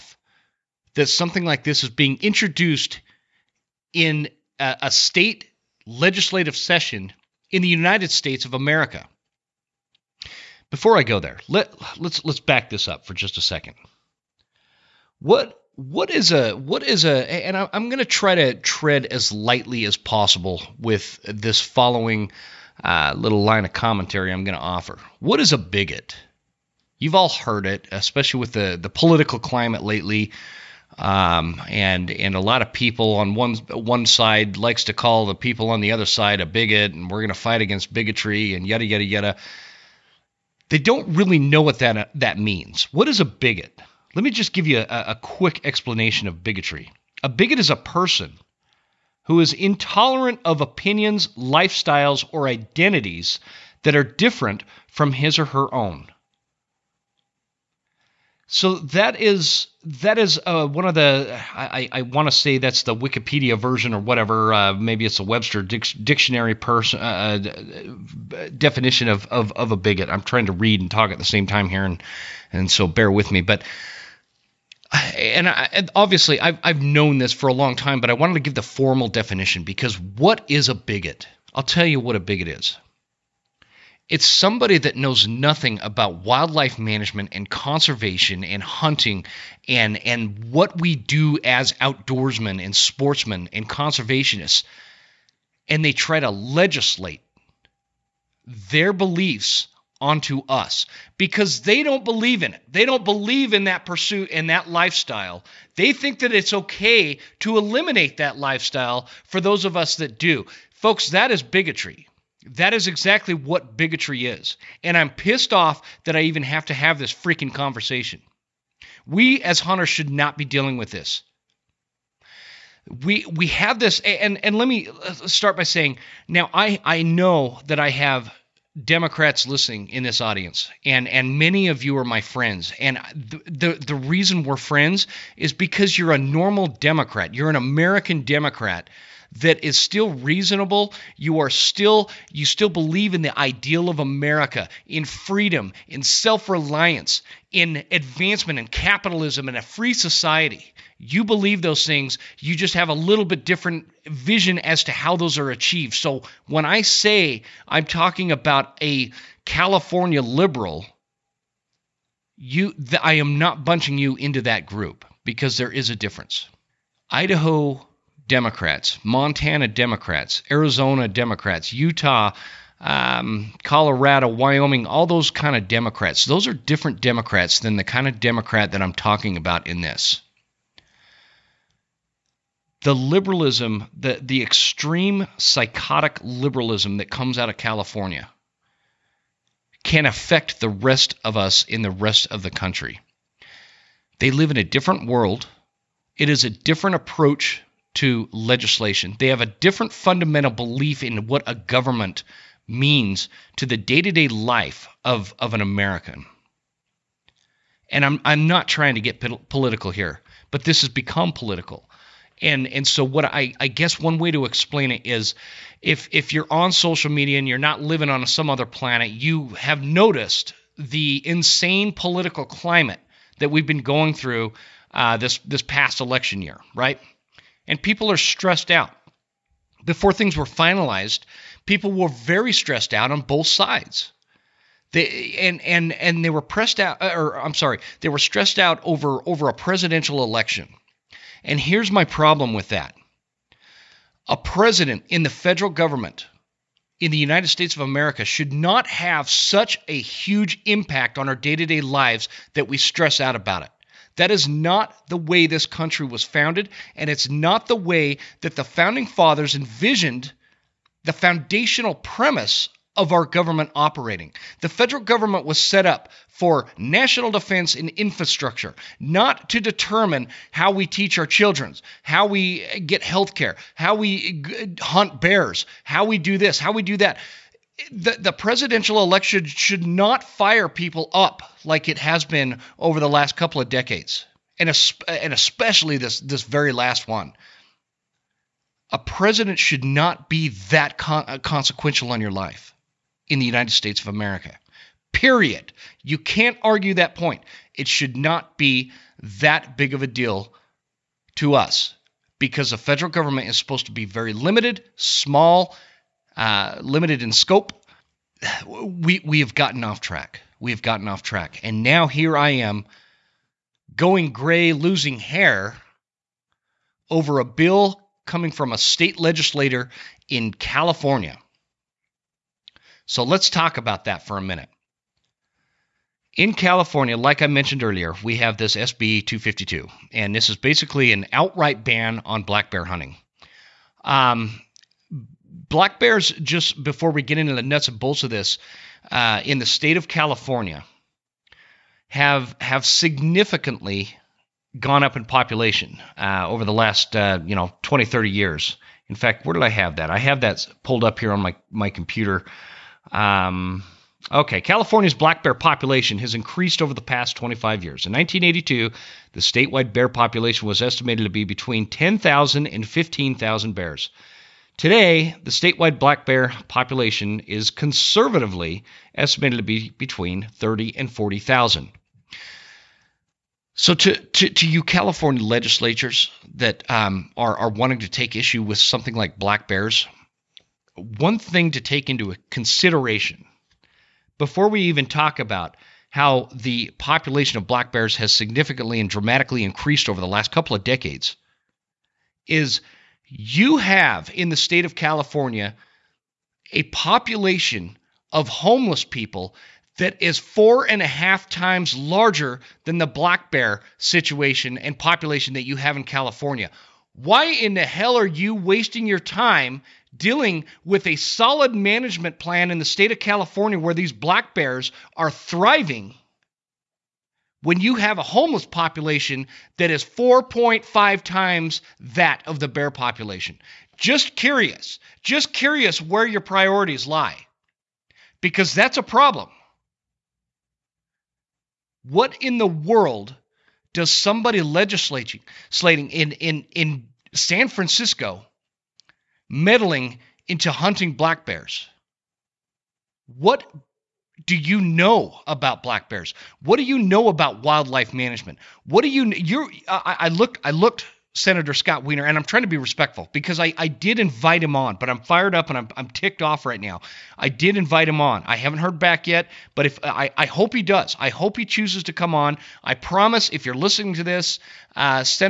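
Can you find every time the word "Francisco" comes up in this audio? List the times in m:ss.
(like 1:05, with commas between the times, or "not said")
7:17.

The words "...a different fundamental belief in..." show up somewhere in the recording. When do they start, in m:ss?
3:19.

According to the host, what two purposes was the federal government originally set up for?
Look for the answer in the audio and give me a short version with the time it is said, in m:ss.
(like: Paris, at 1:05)
National defense and infrastructure, at 4:26.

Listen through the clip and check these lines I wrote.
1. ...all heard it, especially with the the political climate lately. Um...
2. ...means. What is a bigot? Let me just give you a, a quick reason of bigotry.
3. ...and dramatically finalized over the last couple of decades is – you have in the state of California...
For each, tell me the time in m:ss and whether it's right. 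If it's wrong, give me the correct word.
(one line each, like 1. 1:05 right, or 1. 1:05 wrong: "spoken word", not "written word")
1. 0:27 right
2. 0:42 wrong: "explanation", not "reason"
3. 6:28 wrong: "increased", not "finalized".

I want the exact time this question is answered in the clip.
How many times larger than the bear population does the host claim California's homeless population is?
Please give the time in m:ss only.
7:00.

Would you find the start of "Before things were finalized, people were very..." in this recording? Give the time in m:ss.
3:49.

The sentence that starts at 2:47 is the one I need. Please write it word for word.
Idaho Democrats, Montana Democrats, Arizona Democrats, Utah, um, Colorado, Wyoming, all those kind of Democrats.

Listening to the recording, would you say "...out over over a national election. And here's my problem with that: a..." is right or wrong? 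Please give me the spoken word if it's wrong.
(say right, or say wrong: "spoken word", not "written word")
wrong: "presidential", not "national".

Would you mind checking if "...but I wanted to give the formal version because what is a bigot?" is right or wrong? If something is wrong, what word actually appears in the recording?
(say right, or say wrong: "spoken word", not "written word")
wrong: "definition", not "version".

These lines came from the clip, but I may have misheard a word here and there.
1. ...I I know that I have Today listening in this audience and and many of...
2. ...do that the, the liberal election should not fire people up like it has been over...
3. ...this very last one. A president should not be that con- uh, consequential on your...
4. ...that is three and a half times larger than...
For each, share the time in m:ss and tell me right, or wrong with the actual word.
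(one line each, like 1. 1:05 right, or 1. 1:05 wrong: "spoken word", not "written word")
1. 2:06 wrong: "Democrats", not "Today"
2. 4:36 wrong: "presidential", not "liberal"
3. 4:46 right
4. 6:39 wrong: "four", not "three".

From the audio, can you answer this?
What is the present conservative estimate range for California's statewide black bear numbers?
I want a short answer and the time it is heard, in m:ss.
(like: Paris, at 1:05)
30,000 to 40,000, at 6:09.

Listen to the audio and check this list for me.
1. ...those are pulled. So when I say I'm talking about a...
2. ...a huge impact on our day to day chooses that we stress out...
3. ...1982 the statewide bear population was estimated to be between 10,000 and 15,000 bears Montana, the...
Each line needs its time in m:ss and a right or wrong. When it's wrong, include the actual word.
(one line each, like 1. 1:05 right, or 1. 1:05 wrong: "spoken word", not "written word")
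1. 2:35 wrong: "achieved", not "pulled"
2. 4:09 wrong: "lives", not "chooses"
3. 5:58 wrong: "Today", not "Montana".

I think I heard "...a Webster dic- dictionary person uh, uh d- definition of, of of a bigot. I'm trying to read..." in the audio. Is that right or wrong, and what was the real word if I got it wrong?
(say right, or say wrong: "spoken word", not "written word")
right.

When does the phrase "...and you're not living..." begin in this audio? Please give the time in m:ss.
3:37.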